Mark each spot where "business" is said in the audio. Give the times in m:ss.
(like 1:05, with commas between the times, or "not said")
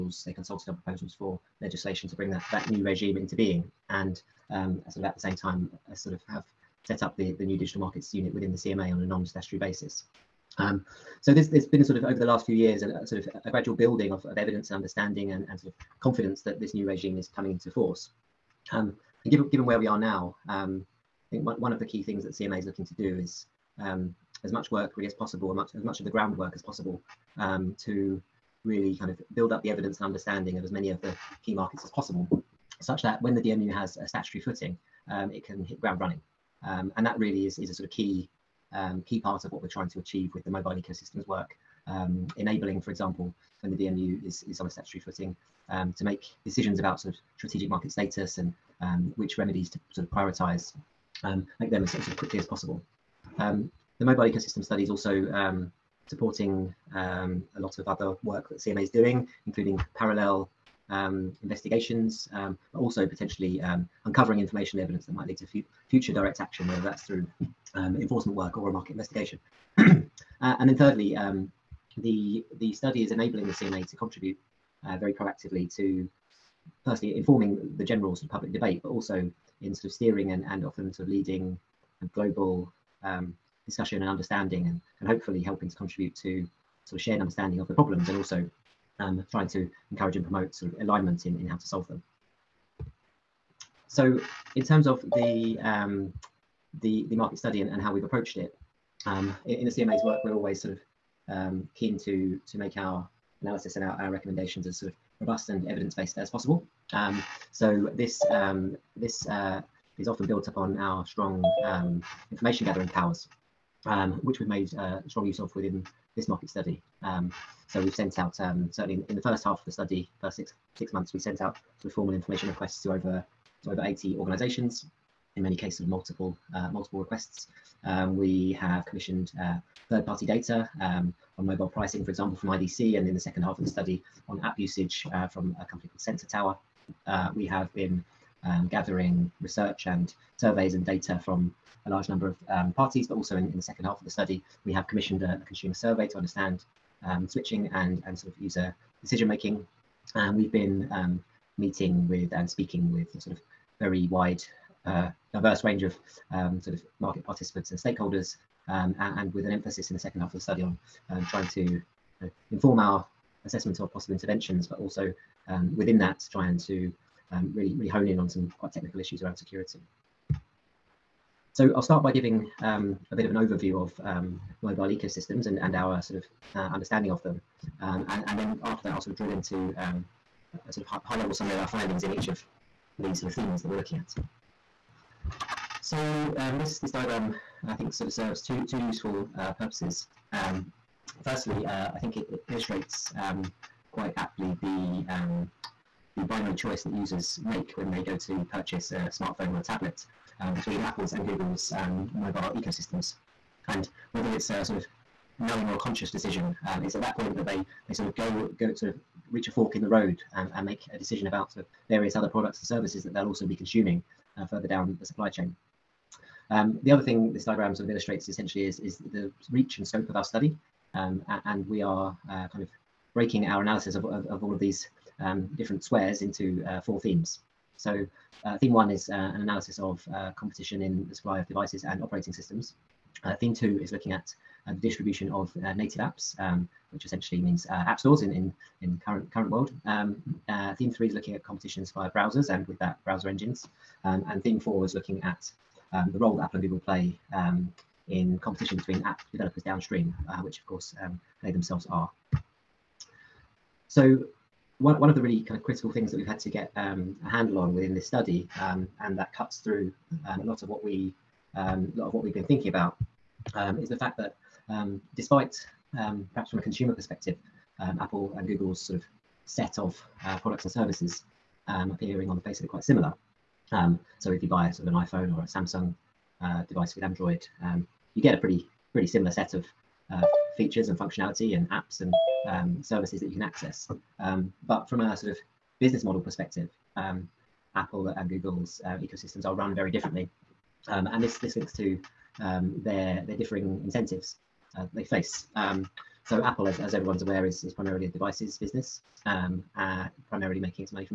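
4:45, 4:58.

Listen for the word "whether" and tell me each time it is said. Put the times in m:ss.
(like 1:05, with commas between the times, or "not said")
1:06, 3:24.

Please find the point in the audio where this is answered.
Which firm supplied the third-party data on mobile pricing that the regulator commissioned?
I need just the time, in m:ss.
2:12.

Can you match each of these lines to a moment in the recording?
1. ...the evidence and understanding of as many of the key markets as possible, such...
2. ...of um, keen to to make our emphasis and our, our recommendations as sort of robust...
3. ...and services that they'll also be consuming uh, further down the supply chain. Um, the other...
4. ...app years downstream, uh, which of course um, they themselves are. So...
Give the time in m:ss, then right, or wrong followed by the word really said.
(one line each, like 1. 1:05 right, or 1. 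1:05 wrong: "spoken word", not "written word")
1. 0:29 right
2. 1:40 wrong: "analysis", not "emphasis"
3. 3:32 right
4. 4:09 wrong: "developers", not "years".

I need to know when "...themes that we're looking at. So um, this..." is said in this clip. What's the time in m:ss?
3:03.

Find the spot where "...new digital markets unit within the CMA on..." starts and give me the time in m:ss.
0:07.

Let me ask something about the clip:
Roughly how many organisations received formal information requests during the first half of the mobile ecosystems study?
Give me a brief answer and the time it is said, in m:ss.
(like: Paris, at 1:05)
over 80, at 2:03.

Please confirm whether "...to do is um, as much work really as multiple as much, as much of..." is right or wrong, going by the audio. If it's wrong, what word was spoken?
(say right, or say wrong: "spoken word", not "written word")
wrong: "possible", not "multiple".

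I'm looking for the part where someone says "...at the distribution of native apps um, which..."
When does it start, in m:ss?
3:54.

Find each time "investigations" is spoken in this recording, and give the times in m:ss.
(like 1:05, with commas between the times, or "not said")
1:01, 1:08.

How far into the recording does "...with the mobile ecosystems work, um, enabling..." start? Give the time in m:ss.
0:40.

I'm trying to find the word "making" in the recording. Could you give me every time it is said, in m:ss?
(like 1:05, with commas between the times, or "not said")
2:29, 5:00.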